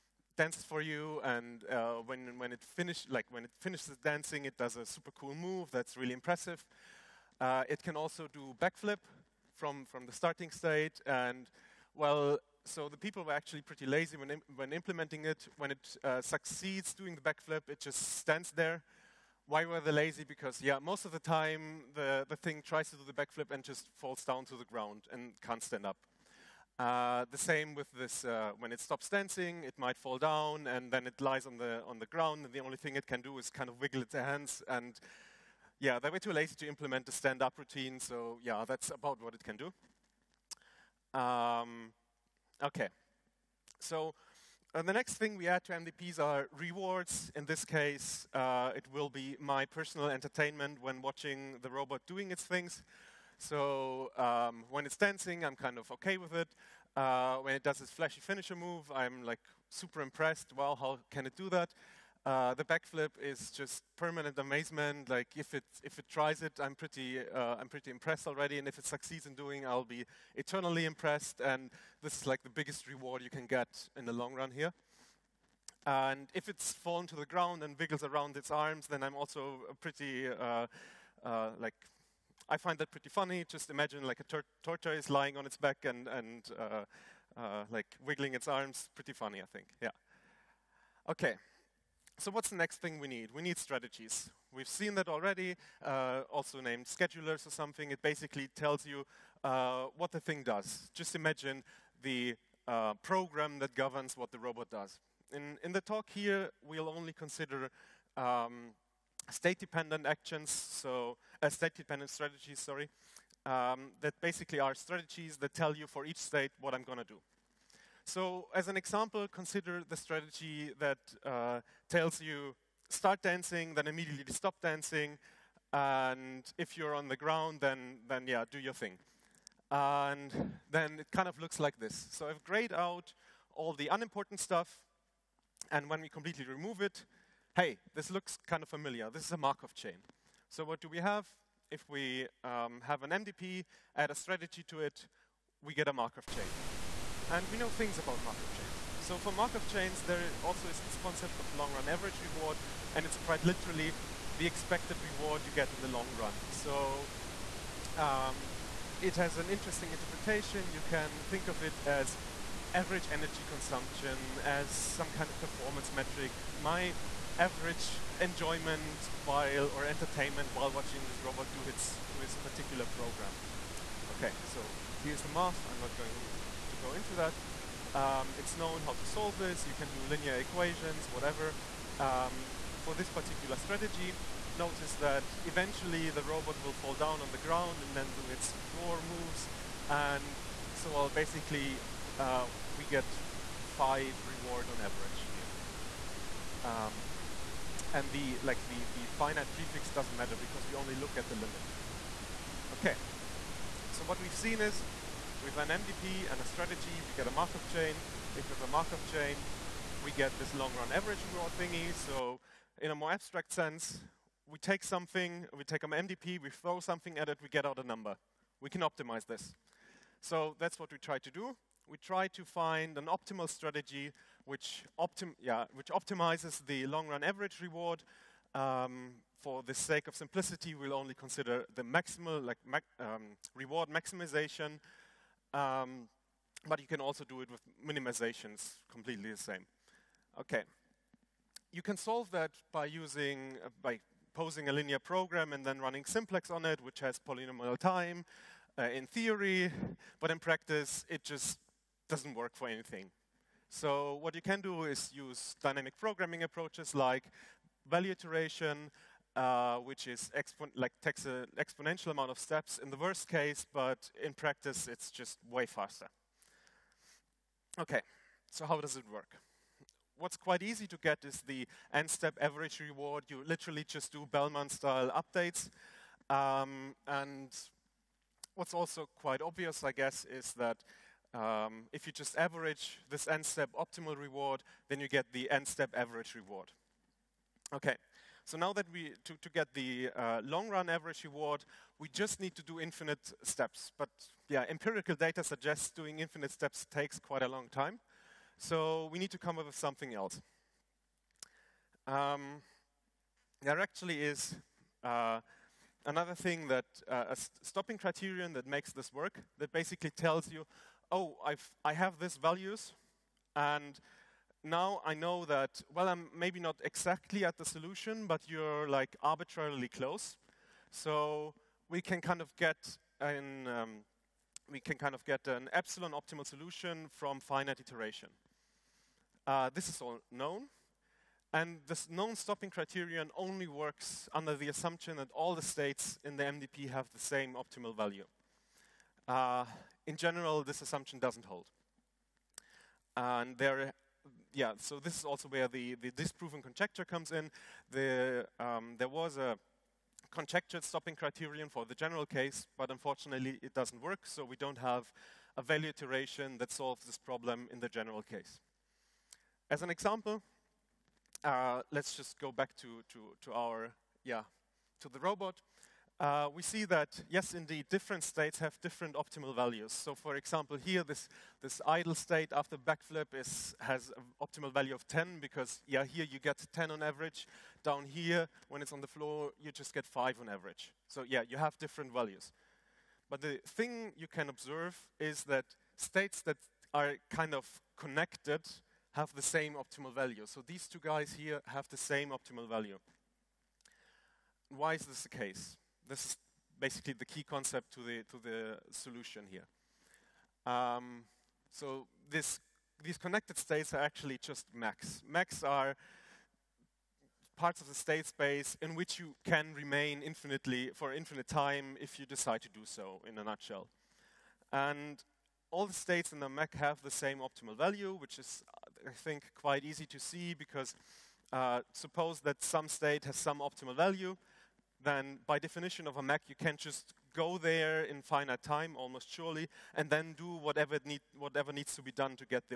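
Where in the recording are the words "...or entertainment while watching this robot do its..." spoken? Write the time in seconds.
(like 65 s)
169 s.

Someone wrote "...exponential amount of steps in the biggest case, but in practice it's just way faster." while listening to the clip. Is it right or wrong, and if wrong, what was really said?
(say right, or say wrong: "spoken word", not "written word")
wrong: "worst", not "biggest".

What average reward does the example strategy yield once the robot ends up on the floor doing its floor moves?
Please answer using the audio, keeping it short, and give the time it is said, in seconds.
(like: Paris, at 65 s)
5, at 193 s.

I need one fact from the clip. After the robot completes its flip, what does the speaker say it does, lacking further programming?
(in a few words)
Just stands there.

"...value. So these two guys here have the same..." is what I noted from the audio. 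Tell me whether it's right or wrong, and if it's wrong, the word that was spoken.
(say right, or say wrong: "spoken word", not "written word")
right.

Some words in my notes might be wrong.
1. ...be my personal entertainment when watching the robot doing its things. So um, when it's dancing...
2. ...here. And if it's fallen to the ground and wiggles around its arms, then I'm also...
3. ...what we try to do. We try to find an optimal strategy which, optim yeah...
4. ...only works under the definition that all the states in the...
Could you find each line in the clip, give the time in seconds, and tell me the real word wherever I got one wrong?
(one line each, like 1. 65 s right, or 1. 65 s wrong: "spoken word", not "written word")
1. 49 s right
2. 74 s right
3. 220 s right
4. 333 s wrong: "assumption", not "definition".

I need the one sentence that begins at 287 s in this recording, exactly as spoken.
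Okay, so now that we, to, to get the uh, long run average reward, we just need to do infinite steps.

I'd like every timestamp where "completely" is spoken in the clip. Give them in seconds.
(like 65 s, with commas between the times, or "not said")
136 s, 238 s.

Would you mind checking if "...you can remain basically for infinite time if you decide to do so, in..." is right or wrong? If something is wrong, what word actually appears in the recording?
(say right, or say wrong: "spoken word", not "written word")
wrong: "infinitely", not "basically".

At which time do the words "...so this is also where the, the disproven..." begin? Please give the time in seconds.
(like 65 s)
344 s.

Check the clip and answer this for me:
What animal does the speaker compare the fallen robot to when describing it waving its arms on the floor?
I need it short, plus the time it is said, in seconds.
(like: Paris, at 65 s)
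Tortoise, at 84 s.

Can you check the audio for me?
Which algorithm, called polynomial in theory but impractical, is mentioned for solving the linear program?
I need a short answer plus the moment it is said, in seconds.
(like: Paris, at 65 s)
Simplex, at 246 s.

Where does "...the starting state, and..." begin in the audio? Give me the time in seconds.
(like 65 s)
10 s.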